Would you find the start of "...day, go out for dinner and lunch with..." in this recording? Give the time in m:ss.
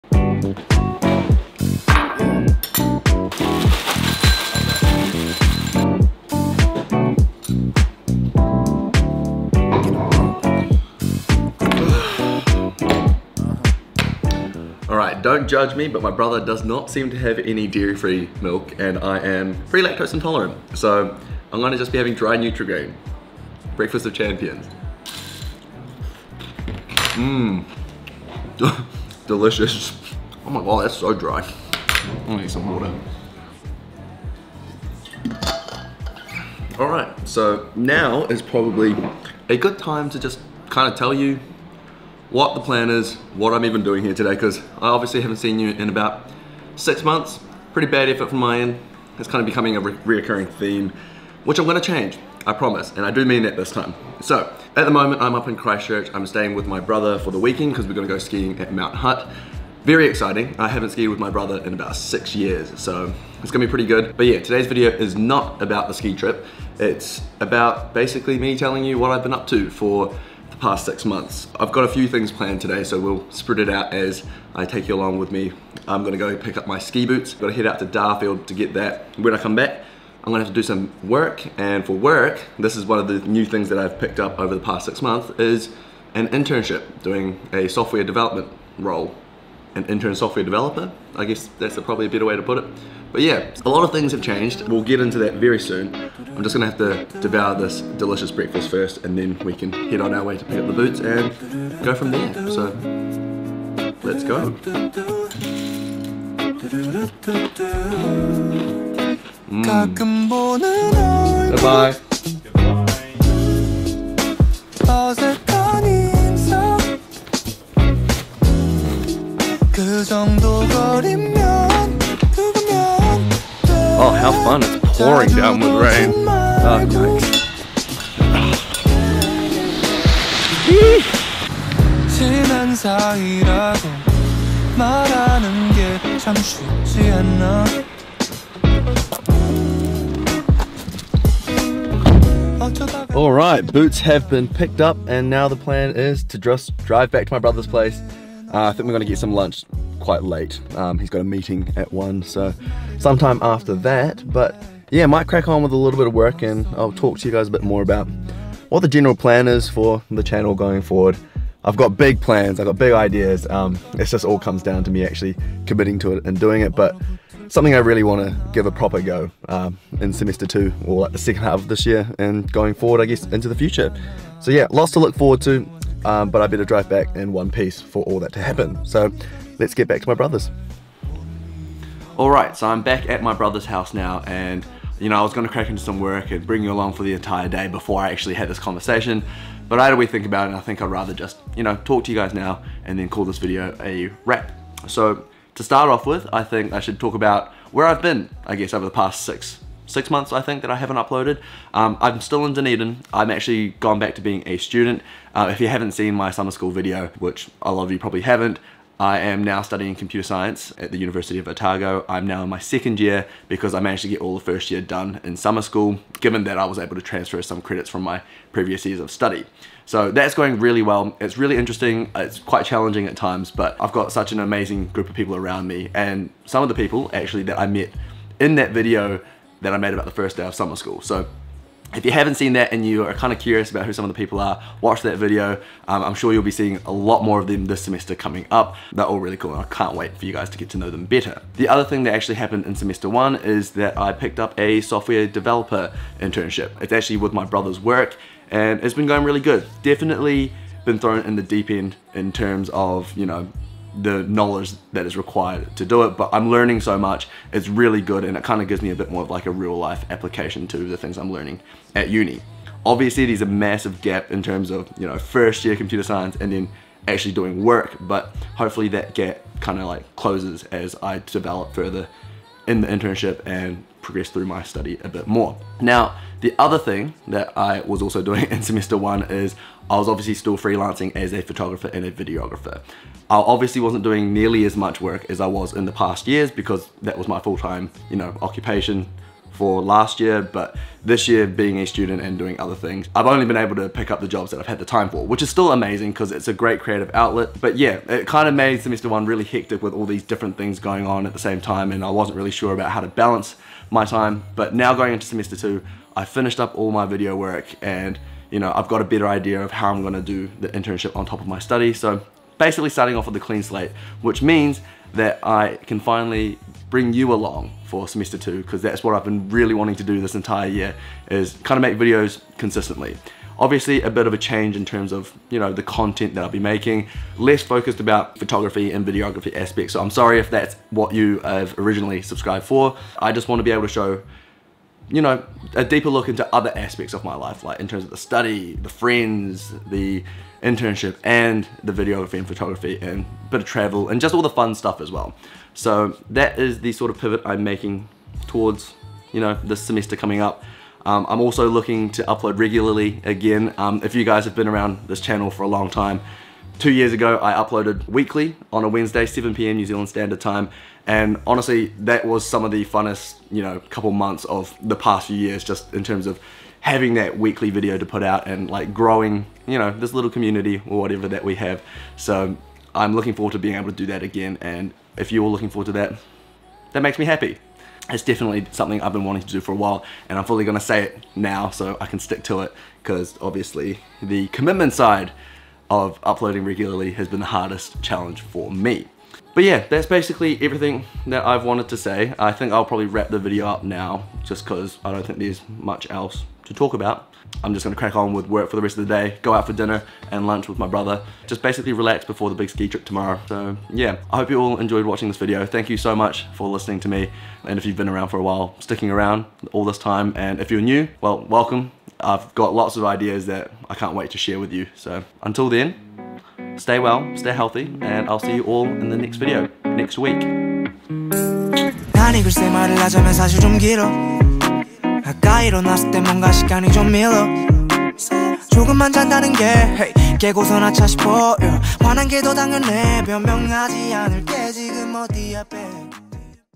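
6:39.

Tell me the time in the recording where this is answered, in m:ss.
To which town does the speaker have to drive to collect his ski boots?
1:17.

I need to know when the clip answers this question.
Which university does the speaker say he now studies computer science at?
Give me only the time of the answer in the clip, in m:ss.
3:30.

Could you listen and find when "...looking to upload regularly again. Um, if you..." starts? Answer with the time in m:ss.
5:51.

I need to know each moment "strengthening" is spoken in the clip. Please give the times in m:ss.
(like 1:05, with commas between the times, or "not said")
not said.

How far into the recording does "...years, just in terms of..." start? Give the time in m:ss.
6:05.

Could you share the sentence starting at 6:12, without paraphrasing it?
So I'm looking forward to being able to do that again.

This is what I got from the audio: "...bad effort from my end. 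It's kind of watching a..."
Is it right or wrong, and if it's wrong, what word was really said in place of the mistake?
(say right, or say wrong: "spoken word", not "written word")
wrong: "becoming", not "watching".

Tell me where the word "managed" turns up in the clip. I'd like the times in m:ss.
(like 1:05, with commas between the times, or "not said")
3:33.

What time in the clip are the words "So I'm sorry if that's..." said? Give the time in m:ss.
5:29.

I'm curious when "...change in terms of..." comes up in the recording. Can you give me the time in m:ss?
5:24.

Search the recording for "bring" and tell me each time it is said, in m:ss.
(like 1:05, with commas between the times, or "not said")
3:06, 5:16.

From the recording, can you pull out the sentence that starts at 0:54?
So, at the moment, I'm up in Christchurch.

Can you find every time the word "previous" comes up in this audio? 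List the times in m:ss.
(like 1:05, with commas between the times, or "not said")
3:38.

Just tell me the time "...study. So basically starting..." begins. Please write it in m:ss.
5:11.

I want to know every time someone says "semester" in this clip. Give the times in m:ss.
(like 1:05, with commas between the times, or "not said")
2:50, 3:57, 4:02, 4:38, 4:58, 5:05, 5:18, 5:49.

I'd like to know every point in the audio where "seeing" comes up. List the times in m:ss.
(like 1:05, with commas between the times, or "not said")
3:56.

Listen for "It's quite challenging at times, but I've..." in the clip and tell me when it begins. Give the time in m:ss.
3:42.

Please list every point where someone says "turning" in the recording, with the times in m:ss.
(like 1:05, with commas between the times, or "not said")
not said.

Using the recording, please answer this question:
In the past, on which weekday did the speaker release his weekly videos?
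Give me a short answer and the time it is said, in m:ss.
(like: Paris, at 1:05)
Wednesday, at 5:58.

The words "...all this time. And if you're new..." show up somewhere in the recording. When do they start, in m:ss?
6:49.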